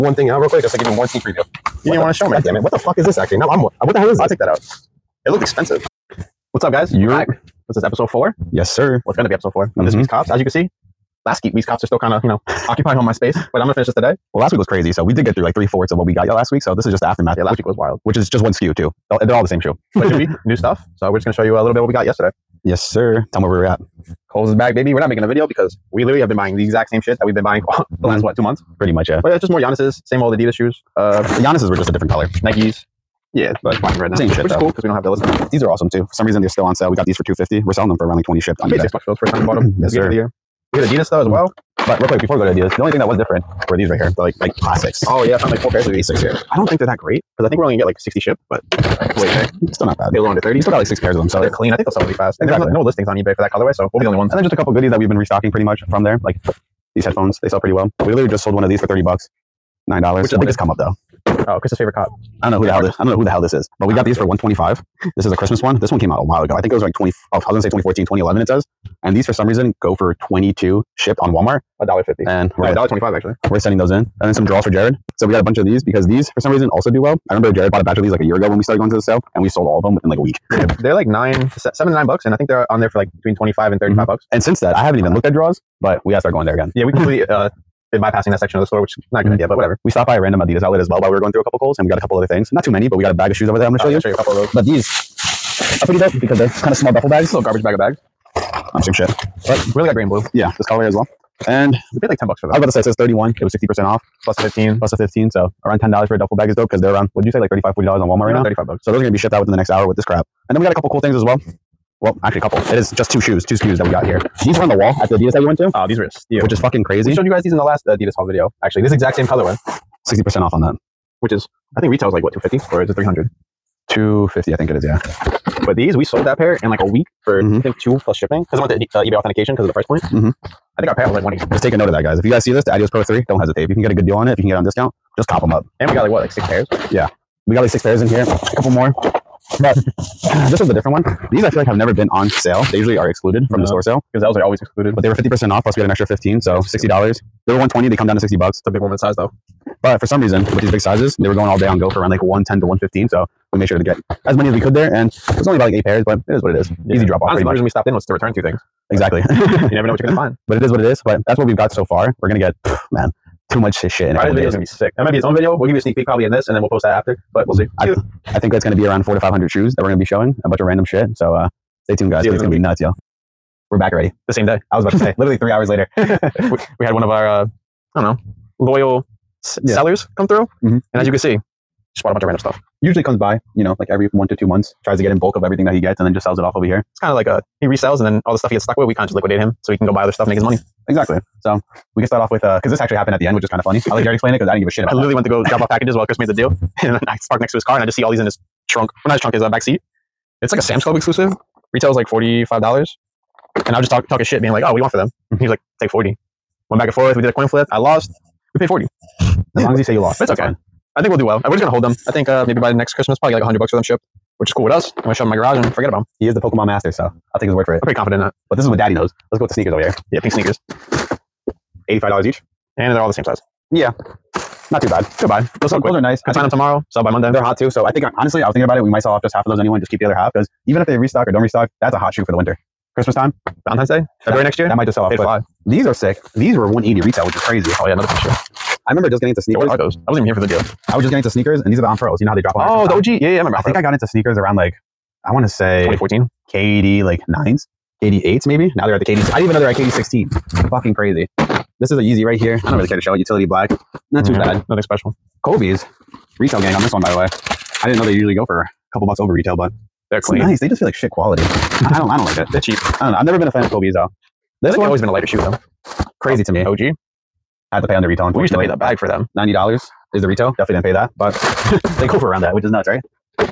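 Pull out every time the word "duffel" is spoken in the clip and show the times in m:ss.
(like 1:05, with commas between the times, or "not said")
1:36, 1:46.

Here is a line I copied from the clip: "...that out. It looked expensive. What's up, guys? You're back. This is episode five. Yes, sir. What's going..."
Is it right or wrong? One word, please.
wrong.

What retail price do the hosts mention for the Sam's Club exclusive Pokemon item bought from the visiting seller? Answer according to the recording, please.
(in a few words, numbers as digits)
$45.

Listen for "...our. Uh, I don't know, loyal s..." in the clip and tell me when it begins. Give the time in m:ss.
2:57.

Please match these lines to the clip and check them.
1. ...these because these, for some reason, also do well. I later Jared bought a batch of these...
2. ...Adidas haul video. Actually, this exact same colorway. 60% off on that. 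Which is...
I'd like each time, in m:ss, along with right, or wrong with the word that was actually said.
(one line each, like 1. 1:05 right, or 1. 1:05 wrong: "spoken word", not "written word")
1. 1:15 wrong: "remember", not "later"
2. 1:57 right.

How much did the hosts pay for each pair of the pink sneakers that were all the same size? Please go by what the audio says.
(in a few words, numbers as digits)
$85.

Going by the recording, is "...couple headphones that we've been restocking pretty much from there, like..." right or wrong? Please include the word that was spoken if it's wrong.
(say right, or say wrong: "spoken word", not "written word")
wrong: "goodies", not "headphones".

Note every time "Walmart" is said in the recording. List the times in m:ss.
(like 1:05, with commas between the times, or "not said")
1:11, 1:48.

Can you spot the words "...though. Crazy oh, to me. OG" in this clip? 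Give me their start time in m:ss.
4:25.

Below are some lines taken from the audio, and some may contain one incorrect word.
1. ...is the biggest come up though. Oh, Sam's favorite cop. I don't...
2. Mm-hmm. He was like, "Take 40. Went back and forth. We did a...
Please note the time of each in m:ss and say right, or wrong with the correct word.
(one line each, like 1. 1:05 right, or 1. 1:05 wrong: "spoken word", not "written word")
1. 1:00 wrong: "Chris", not "Sam"
2. 3:25 right.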